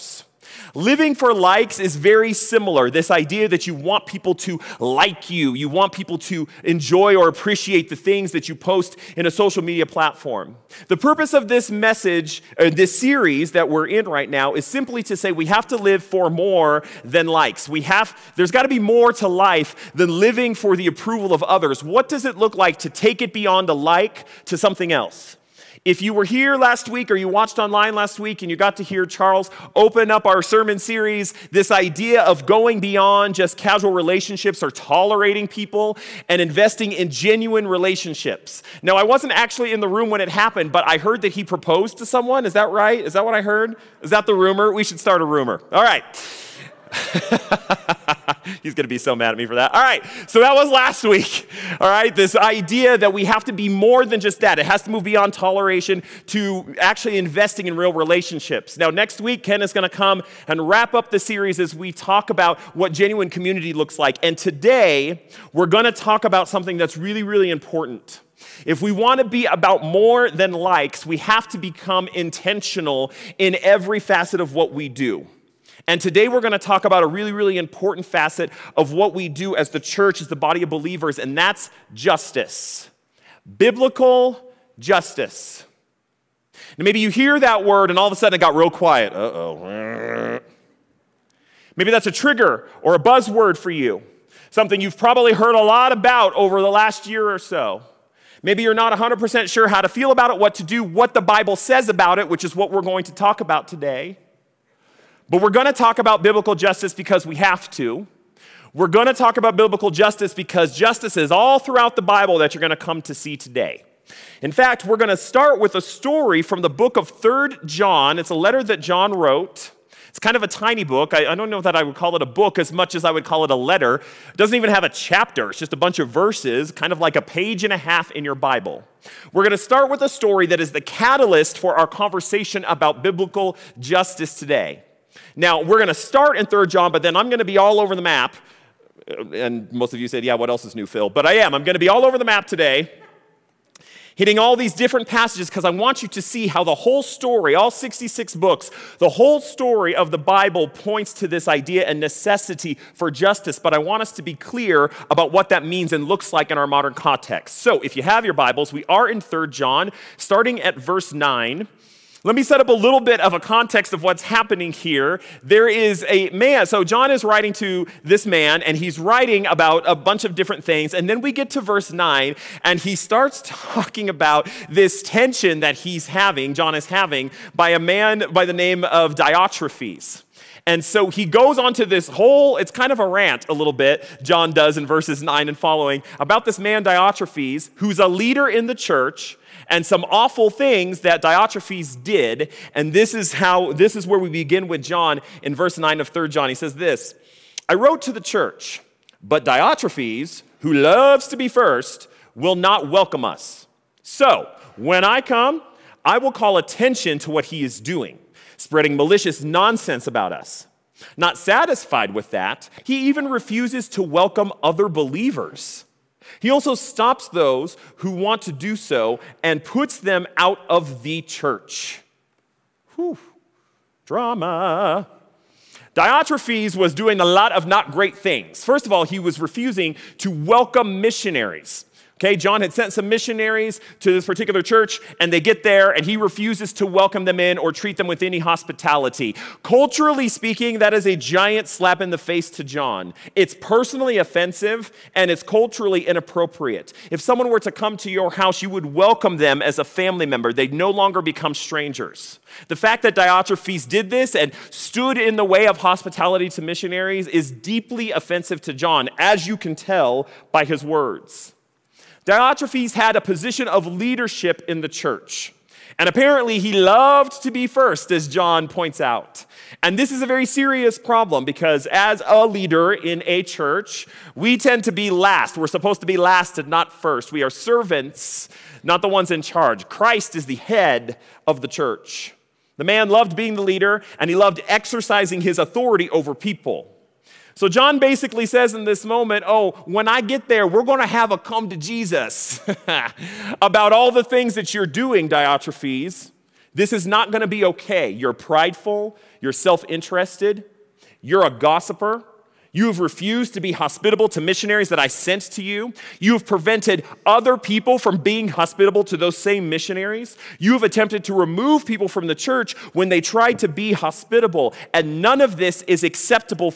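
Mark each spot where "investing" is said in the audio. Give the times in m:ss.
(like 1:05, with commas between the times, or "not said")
0:36, 0:57.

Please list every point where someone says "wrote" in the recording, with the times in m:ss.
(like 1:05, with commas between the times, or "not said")
1:59, 3:17.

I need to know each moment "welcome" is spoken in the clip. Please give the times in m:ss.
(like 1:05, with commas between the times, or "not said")
3:22, 3:34, 3:50, 3:56, 4:08.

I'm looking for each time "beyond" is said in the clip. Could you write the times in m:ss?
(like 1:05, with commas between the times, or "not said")
0:23, 0:32, 0:55.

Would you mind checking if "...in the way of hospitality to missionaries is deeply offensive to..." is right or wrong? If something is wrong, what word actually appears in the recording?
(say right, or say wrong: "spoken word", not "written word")
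right.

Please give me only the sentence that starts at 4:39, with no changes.
Christ is the head of the church.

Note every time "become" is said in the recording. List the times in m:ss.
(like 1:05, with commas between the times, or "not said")
1:11, 4:11.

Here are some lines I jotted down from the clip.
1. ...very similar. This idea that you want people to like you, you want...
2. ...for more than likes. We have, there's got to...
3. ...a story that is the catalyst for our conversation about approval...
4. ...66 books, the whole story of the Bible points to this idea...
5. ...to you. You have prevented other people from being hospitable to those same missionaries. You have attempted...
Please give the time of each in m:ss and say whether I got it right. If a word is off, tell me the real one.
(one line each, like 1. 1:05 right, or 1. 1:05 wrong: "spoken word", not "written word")
1. 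0:01 right
2. 0:16 right
3. 2:09 wrong: "biblical", not "approval"
4. 2:27 right
5. 5:05 right.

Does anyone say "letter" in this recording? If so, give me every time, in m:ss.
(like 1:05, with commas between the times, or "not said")
1:58, 2:03.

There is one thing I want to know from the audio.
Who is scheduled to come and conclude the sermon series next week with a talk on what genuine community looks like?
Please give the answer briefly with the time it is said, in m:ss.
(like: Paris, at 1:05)
Ken, at 0:59.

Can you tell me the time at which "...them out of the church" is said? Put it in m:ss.
3:39.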